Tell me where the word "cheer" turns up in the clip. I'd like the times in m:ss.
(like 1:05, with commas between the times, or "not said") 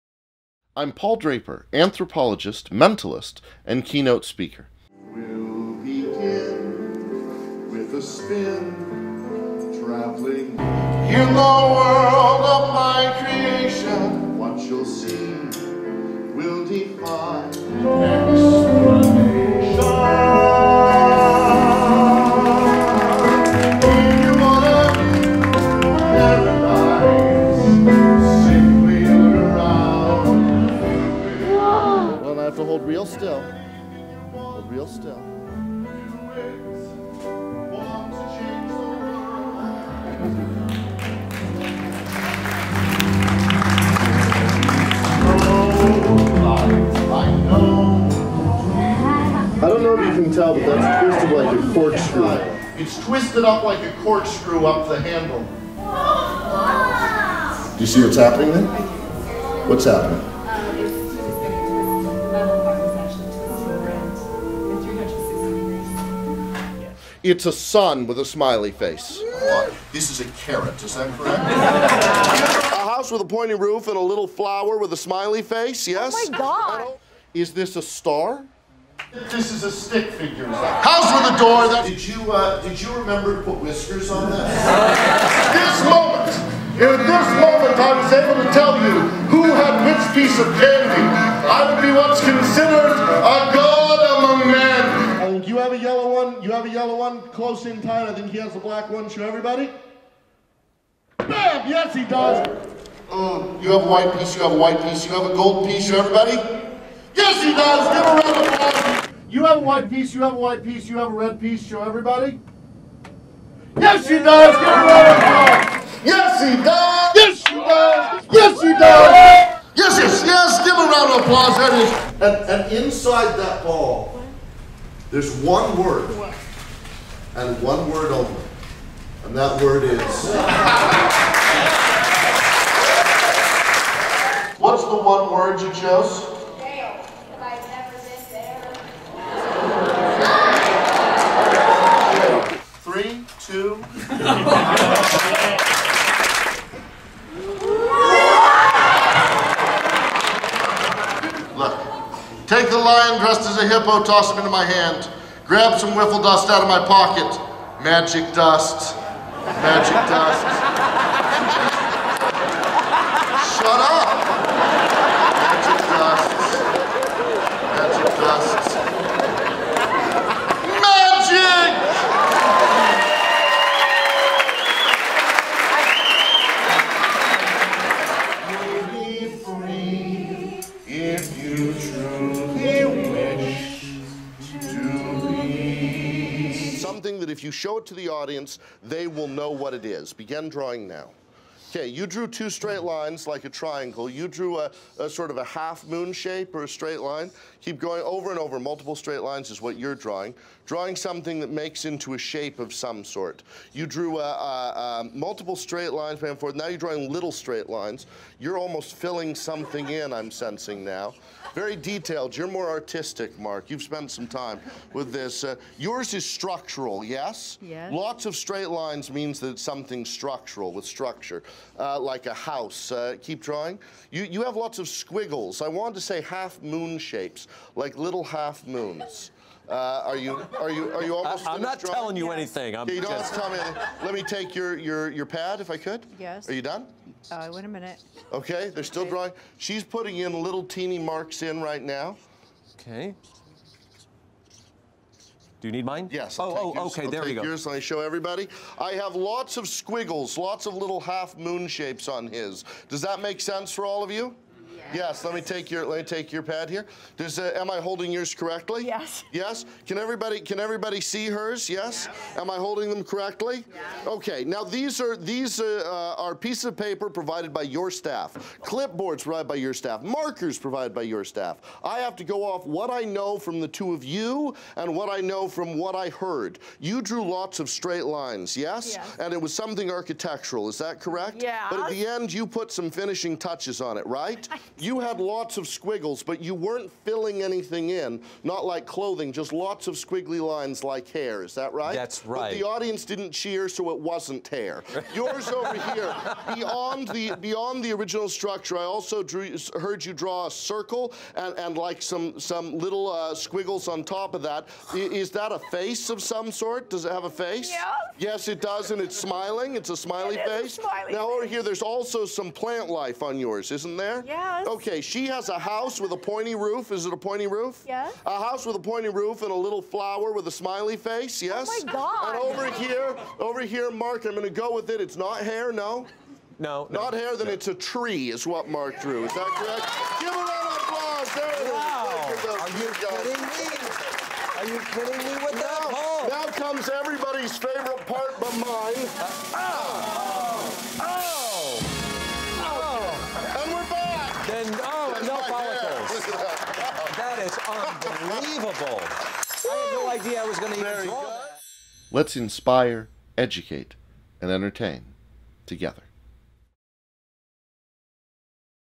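4:53.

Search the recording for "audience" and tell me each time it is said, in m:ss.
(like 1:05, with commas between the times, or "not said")
3:08, 4:52.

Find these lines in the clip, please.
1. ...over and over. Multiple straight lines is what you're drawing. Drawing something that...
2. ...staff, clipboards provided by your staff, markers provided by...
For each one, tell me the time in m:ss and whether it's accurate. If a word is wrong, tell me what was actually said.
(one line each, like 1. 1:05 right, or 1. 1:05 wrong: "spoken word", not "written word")
1. 3:18 right
2. 4:27 right.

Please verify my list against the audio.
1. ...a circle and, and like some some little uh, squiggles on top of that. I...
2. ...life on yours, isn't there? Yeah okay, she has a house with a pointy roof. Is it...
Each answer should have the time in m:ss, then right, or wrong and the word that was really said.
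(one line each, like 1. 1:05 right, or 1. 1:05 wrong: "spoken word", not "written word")
1. 5:00 right
2. 5:12 right.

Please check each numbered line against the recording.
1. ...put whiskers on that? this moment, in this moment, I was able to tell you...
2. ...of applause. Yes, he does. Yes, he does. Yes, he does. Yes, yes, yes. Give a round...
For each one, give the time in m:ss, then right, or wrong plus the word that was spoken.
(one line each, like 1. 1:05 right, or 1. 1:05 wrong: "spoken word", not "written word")
1. 1:23 right
2. 1:55 right.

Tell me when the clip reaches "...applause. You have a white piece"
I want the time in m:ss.
1:48.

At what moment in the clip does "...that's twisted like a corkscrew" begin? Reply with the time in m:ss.
0:50.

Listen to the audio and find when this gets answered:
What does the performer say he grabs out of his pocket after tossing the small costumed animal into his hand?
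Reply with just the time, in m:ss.
2:35.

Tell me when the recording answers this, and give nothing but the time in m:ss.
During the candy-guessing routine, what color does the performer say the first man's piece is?
1:38.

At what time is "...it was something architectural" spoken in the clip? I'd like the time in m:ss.
4:39.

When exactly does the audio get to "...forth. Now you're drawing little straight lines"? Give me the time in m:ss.
3:26.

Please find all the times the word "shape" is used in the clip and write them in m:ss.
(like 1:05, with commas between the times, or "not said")
3:16, 3:22, 3:46, 4:11.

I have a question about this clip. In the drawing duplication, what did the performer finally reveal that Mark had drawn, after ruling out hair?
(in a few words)
A tree.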